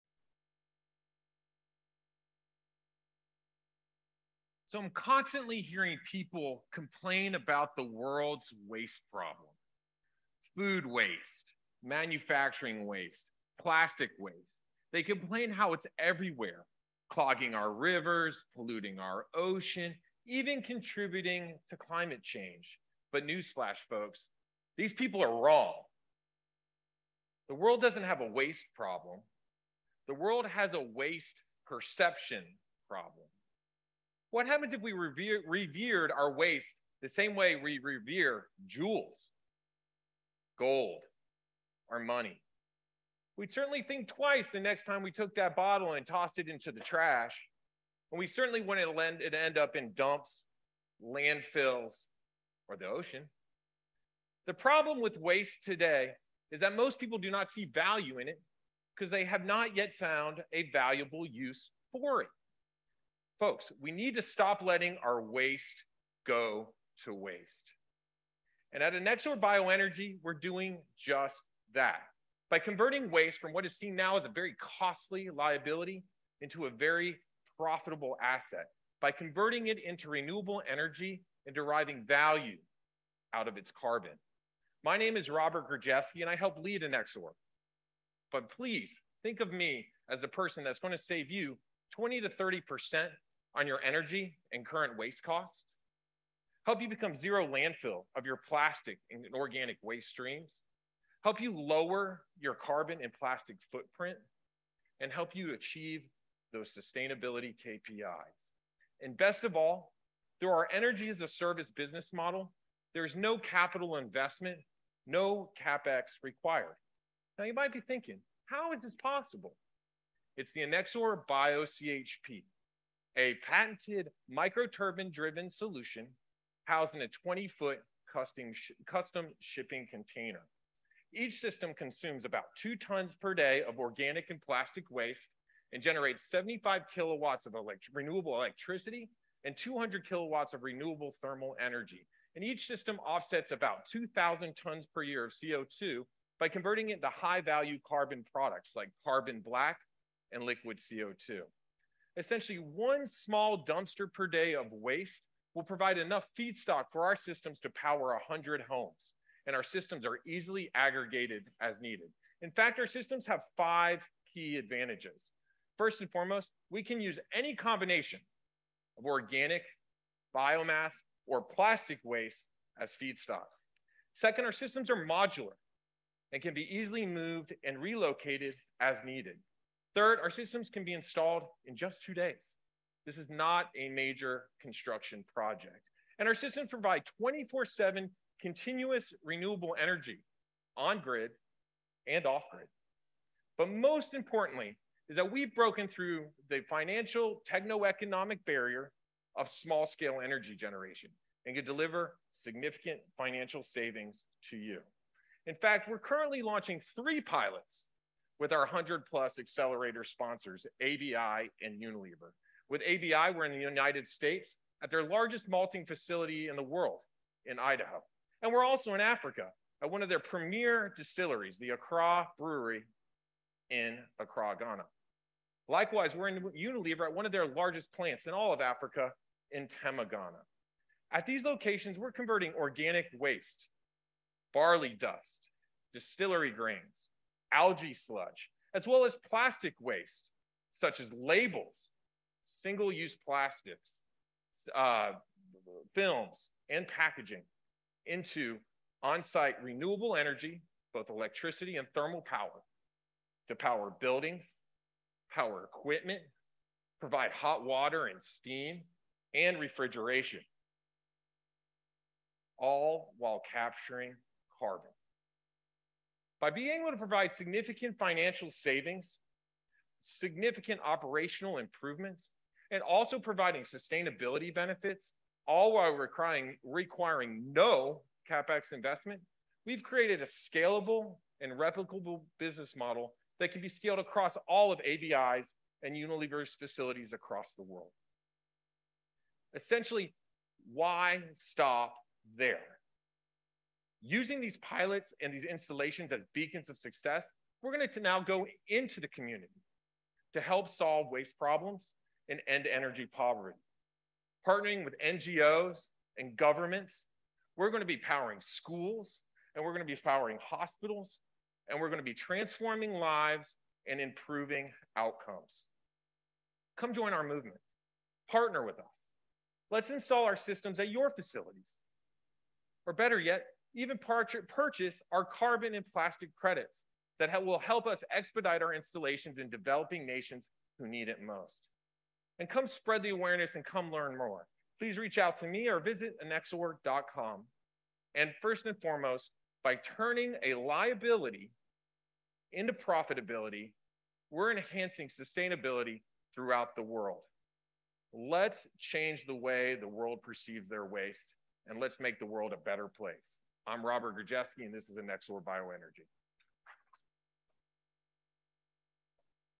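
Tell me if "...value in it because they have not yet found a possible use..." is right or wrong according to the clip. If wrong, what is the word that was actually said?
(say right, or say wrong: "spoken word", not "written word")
wrong: "valuable", not "possible".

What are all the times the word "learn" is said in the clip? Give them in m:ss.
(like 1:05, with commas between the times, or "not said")
5:33.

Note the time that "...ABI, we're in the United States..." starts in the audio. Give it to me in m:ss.
3:32.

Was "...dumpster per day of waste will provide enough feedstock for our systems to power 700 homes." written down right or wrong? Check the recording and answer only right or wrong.
wrong.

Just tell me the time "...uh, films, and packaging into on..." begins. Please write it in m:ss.
4:04.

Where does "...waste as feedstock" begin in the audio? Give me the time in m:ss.
2:52.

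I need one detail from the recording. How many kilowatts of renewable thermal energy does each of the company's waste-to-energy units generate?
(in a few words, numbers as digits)
200.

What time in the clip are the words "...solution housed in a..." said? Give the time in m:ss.
2:05.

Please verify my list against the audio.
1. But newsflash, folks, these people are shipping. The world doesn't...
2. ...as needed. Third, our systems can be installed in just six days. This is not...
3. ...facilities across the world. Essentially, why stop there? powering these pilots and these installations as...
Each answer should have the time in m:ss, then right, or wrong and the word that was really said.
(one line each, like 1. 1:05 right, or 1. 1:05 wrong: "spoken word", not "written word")
1. 0:23 wrong: "wrong", not "shipping"
2. 2:58 wrong: "two", not "six"
3. 4:46 wrong: "using", not "powering".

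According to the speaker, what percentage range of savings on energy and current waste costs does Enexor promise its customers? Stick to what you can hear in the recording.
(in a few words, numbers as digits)
20 to 30%.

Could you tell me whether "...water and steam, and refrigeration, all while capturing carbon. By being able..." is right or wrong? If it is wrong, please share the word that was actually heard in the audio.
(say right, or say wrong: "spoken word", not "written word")
right.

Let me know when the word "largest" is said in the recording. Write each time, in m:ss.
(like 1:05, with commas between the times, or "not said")
3:35, 3:47.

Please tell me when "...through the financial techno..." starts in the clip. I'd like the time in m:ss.
3:15.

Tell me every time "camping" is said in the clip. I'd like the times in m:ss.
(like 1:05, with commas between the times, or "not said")
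not said.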